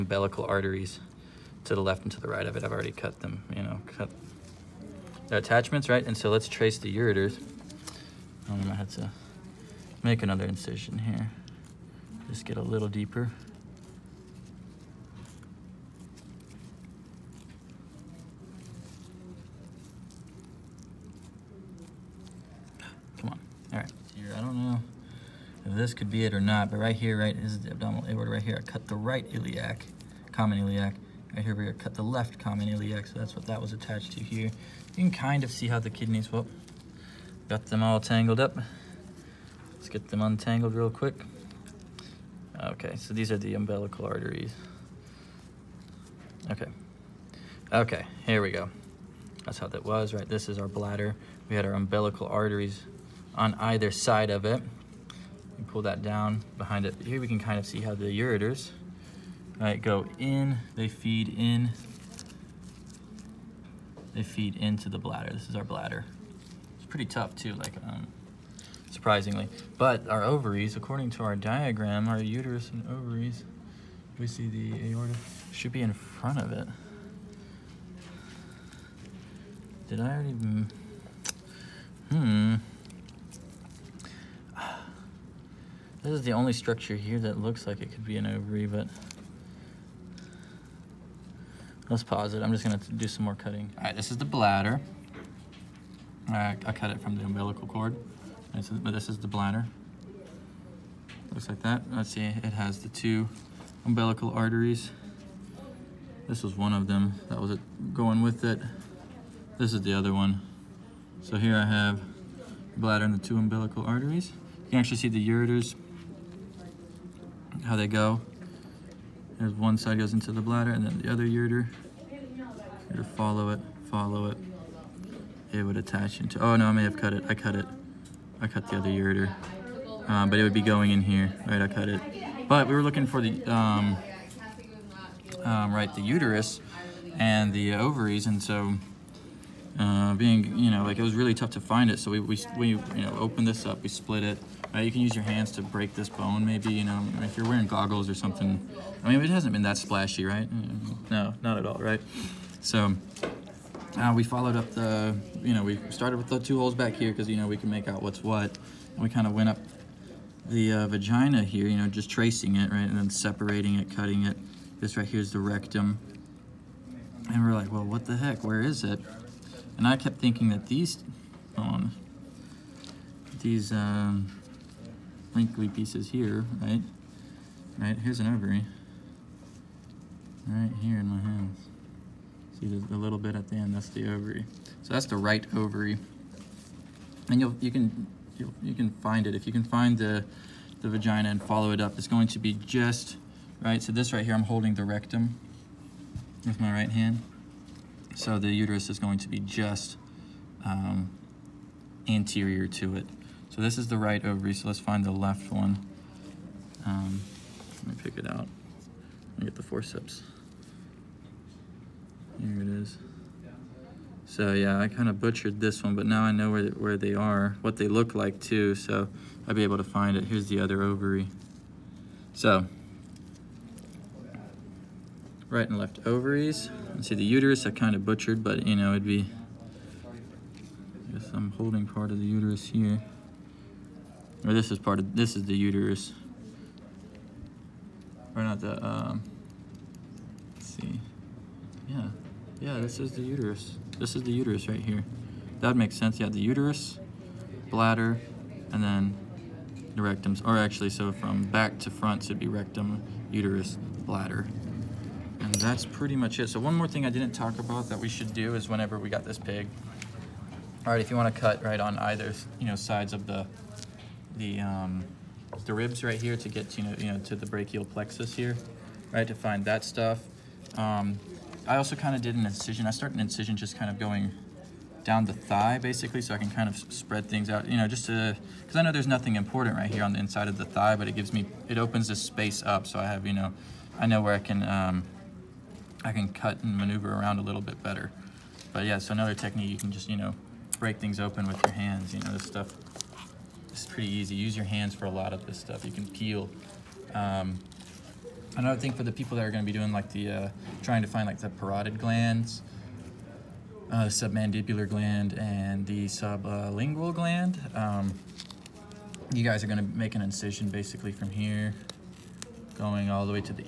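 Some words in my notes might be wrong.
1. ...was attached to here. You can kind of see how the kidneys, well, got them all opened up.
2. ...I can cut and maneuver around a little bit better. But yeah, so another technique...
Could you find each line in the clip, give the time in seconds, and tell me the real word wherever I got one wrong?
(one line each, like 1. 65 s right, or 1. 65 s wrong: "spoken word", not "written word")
1. 33 s wrong: "tangled", not "opened"
2. 286 s right.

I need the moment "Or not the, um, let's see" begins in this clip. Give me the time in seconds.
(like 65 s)
238 s.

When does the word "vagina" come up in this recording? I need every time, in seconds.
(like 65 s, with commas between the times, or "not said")
160 s, 190 s.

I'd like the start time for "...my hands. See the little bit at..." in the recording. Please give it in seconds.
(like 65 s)
181 s.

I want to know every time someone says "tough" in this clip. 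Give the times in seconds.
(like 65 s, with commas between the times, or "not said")
67 s, 141 s.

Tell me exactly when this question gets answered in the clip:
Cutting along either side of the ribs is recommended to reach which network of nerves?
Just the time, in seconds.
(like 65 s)
267 s.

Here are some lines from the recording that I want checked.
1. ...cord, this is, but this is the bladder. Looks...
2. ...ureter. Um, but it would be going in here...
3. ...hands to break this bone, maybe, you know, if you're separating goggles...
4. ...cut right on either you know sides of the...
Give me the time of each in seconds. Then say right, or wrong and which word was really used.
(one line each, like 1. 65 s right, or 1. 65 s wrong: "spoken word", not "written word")
1. 97 s right
2. 128 s right
3. 145 s wrong: "wearing", not "separating"
4. 261 s right.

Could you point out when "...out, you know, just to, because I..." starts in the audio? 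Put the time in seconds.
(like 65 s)
277 s.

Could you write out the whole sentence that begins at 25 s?
this could be it or not, but right here, right, this is the abdominal aorta right here.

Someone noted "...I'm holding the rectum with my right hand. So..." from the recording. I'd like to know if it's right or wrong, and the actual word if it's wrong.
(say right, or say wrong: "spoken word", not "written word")
right.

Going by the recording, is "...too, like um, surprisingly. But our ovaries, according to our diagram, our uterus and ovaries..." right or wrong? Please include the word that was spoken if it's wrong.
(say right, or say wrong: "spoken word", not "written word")
right.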